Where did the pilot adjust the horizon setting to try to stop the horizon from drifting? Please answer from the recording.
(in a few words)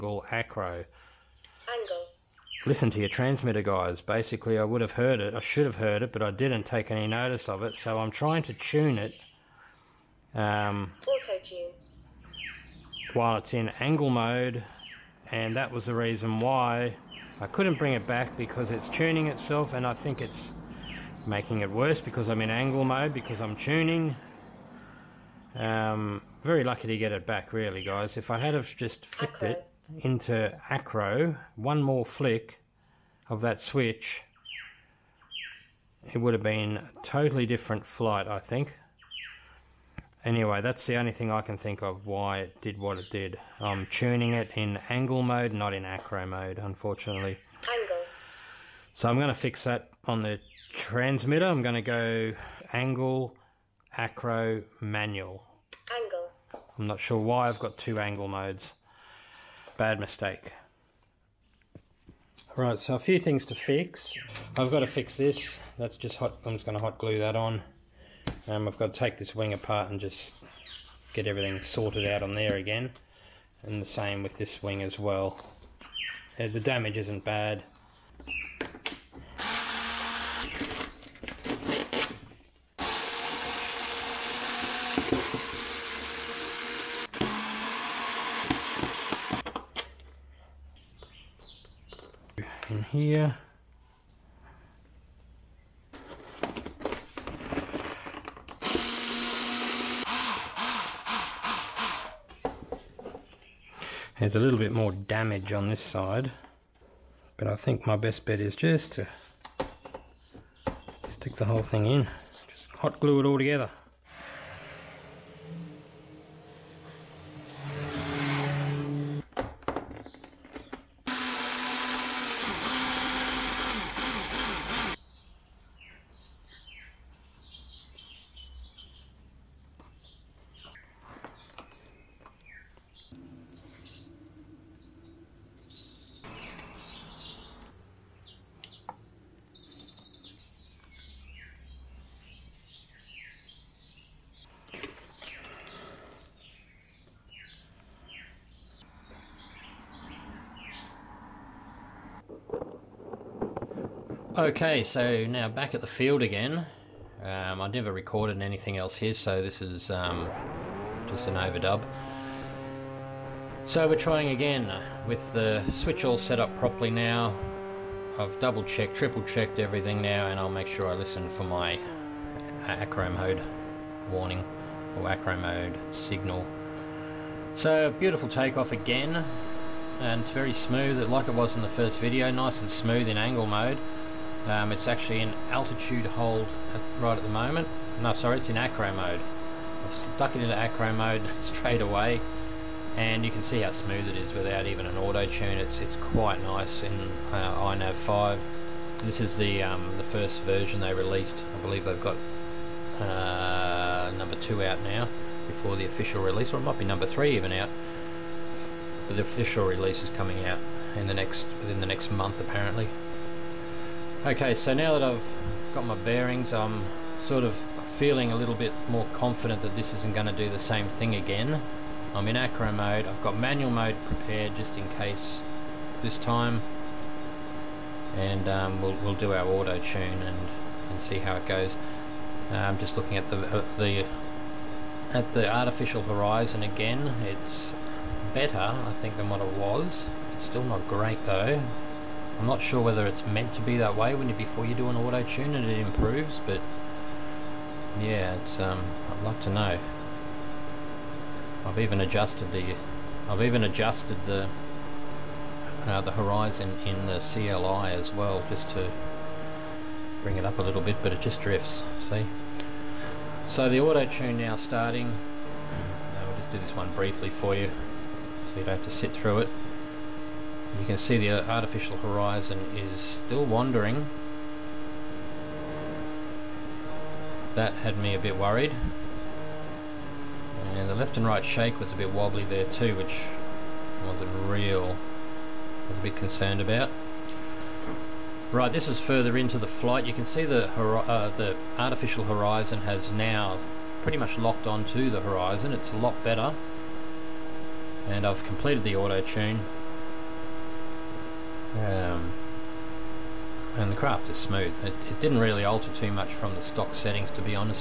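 In the CLI.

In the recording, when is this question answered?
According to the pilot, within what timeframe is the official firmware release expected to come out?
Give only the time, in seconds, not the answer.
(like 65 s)
211 s.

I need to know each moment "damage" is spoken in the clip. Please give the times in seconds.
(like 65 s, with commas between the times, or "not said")
76 s, 104 s.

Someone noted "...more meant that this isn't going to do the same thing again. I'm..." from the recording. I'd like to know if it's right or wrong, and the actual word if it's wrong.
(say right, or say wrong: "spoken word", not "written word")
wrong: "confident", not "meant".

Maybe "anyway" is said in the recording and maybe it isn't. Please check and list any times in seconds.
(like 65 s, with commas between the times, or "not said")
40 s.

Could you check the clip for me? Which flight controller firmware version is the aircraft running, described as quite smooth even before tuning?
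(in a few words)
iNav 5.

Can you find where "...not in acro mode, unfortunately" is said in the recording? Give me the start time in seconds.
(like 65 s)
45 s.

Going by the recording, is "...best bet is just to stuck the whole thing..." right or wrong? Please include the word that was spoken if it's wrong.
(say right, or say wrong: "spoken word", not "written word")
wrong: "stick", not "stuck".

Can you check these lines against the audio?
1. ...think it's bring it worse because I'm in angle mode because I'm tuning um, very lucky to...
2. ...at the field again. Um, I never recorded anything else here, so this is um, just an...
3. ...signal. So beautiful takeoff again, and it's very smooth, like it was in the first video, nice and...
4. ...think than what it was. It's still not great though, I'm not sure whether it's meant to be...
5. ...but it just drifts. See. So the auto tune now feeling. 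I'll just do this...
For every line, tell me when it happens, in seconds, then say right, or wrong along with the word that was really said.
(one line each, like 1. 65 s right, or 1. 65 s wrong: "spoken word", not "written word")
1. 19 s wrong: "making", not "bring"
2. 155 s right
3. 175 s right
4. 239 s right
5. 261 s wrong: "starting", not "feeling".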